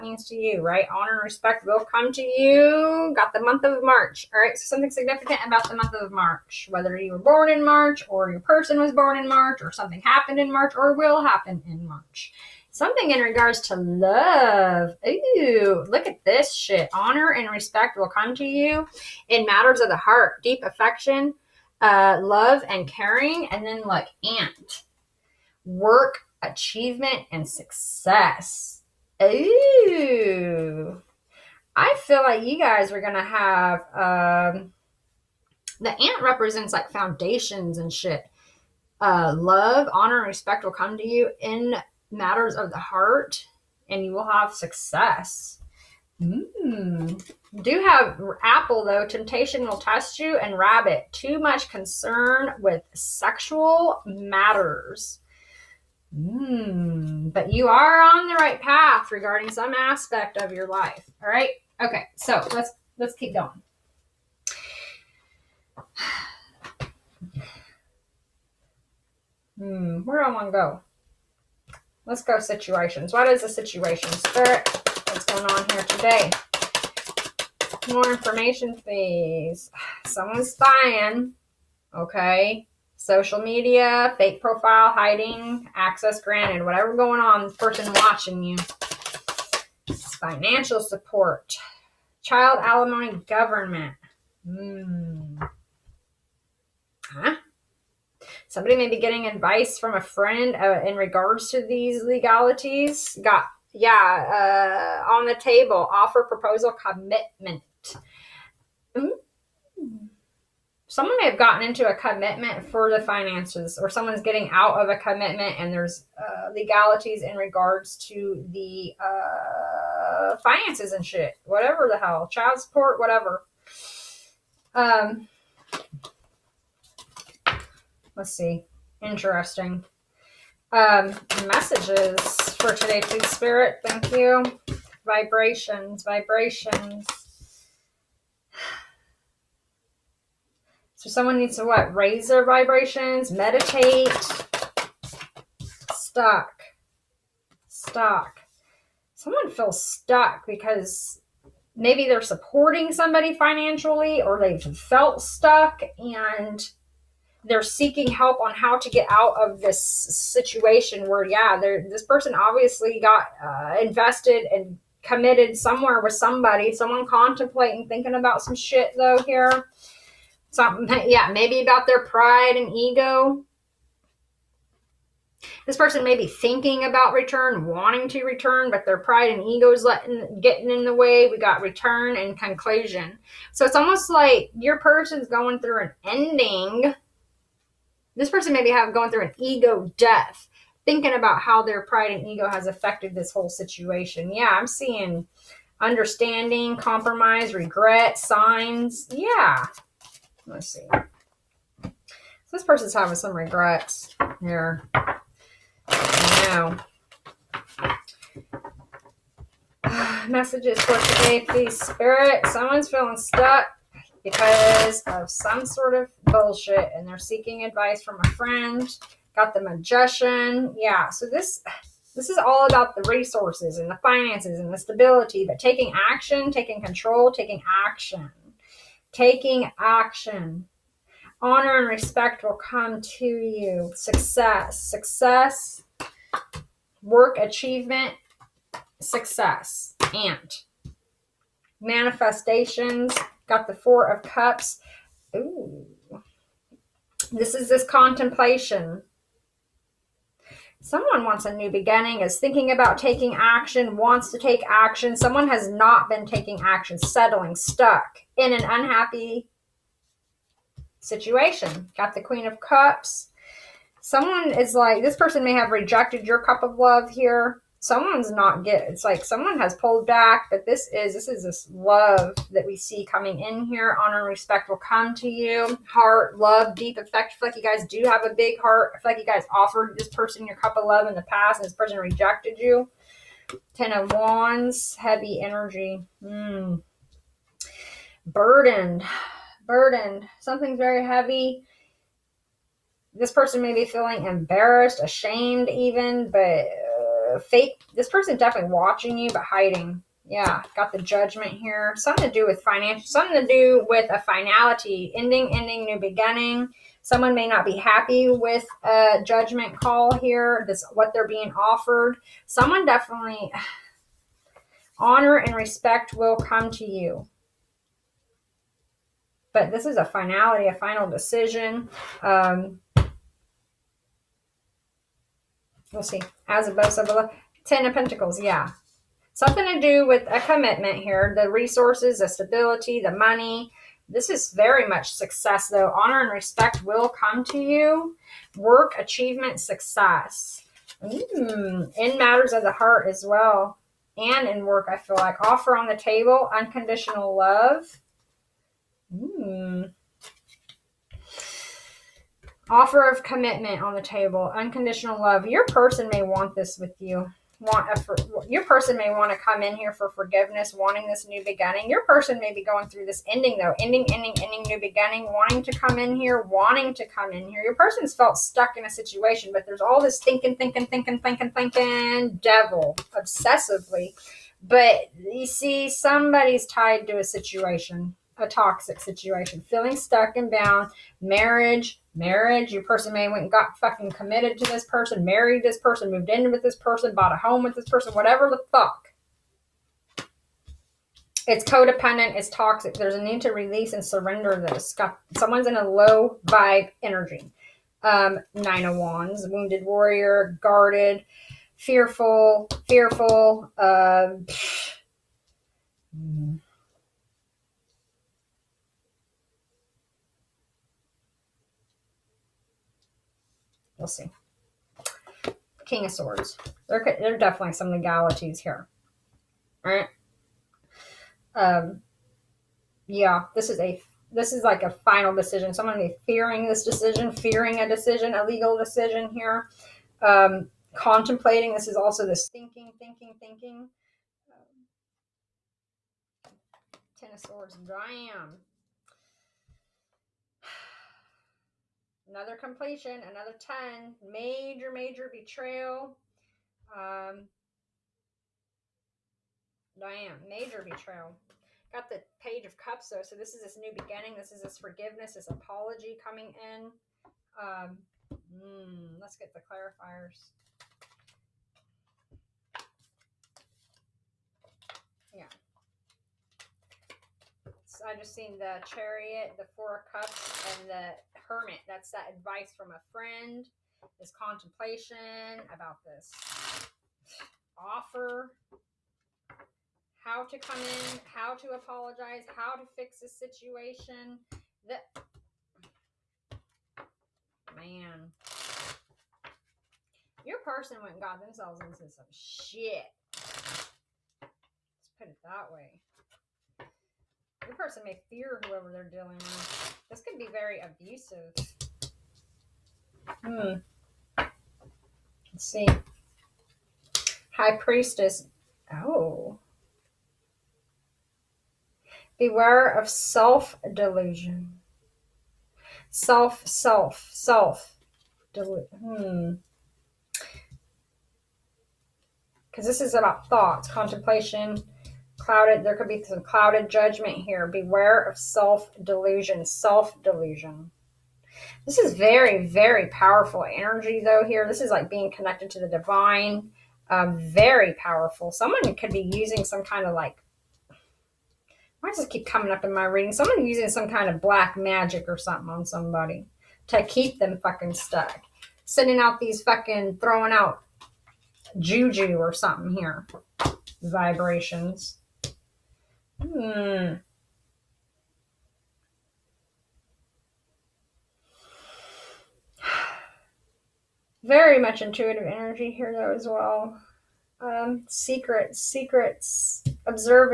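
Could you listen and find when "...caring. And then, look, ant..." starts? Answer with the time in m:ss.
0:22.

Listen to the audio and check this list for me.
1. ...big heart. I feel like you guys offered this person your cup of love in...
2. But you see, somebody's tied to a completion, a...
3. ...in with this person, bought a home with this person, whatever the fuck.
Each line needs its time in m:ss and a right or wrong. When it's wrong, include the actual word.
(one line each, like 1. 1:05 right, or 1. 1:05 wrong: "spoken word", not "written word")
1. 4:38 right
2. 6:14 wrong: "situation", not "completion"
3. 6:26 right.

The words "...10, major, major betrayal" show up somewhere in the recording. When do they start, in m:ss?
7:23.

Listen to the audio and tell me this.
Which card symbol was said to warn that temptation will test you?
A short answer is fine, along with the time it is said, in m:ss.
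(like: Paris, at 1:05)
Apple, at 0:48.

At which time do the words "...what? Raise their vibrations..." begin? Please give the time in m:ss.
2:21.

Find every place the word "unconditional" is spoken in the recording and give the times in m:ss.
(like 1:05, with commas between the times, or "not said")
5:46, 5:54.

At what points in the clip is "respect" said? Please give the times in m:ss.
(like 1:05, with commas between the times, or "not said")
0:01, 0:17, 0:40, 3:51, 4:34, 5:15, 5:36.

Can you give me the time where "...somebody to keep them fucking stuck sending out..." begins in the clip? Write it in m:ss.
9:05.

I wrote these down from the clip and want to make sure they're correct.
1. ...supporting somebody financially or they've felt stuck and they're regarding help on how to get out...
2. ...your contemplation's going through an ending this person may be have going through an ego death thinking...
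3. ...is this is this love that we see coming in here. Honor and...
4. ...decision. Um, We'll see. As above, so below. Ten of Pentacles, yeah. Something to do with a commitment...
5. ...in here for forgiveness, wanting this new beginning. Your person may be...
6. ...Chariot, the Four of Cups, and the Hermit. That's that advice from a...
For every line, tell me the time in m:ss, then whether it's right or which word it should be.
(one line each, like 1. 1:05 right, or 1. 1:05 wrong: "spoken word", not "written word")
1. 2:32 wrong: "seeking", not "regarding"
2. 3:04 wrong: "person", not "contemplation"
3. 4:30 right
4. 5:21 right
5. 5:59 right
6. 7:48 right.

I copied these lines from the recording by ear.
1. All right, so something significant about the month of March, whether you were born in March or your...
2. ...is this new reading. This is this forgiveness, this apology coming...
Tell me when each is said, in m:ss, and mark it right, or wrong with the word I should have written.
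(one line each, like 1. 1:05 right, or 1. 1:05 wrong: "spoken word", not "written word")
1. 0:04 right
2. 7:33 wrong: "beginning", not "reading".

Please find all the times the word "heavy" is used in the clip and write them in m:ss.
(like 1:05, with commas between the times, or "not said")
4:44, 4:51.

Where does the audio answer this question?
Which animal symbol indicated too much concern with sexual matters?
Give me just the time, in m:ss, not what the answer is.
0:50.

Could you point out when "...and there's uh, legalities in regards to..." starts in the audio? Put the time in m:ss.
1:55.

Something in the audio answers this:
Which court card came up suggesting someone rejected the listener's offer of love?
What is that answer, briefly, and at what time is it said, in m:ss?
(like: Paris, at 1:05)
Queen of Cups, at 4:22.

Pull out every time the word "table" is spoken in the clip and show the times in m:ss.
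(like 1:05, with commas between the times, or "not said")
1:45, 5:45, 5:54.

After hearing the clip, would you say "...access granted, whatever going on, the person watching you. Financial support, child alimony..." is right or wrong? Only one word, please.
right.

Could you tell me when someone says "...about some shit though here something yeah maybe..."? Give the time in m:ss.
2:48.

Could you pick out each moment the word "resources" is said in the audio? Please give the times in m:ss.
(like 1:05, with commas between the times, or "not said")
3:43, 5:31.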